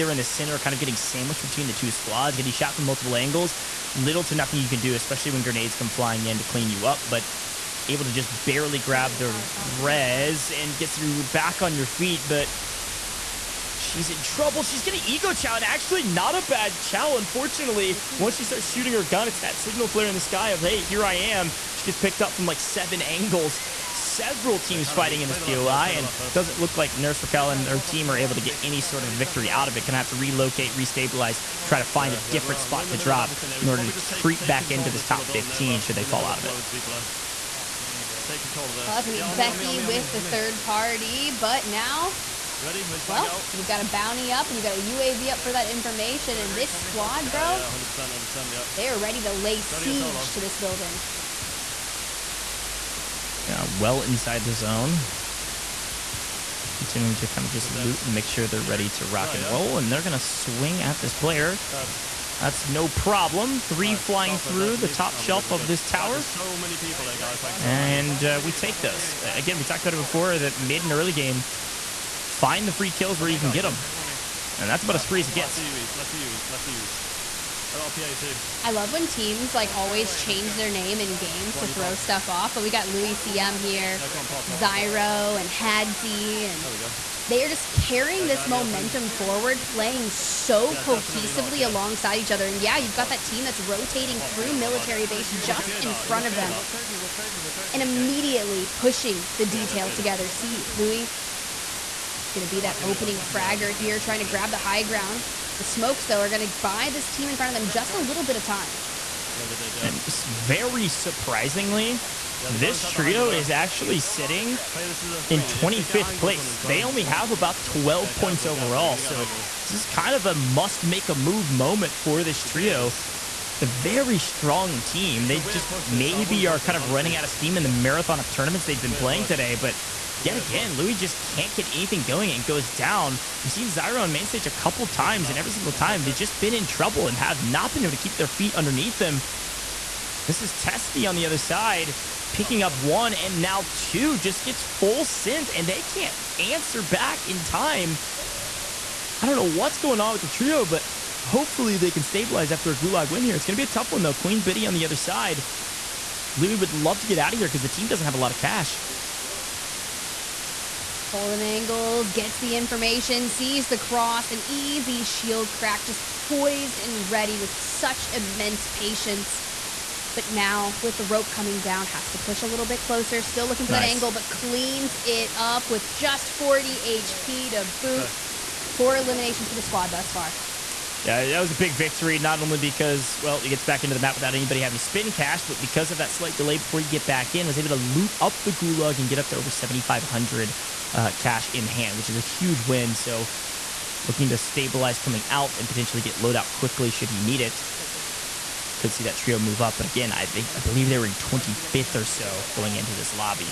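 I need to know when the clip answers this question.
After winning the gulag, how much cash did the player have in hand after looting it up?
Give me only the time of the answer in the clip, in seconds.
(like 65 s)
189 s.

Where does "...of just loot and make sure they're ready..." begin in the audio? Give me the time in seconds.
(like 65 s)
57 s.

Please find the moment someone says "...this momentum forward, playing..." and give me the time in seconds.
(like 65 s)
88 s.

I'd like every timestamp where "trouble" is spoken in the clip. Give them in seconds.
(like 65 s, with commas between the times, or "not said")
14 s, 136 s.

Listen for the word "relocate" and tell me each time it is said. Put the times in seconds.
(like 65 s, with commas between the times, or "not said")
30 s.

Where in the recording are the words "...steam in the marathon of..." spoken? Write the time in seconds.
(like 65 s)
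127 s.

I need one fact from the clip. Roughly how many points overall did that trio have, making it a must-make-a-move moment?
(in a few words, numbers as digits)
12.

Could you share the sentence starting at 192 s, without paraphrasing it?
So looking to stabilize coming out and potentially get loadout quickly should he need it could see that trio move up.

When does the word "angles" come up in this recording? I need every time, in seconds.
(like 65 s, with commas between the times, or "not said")
3 s, 23 s, 161 s, 173 s.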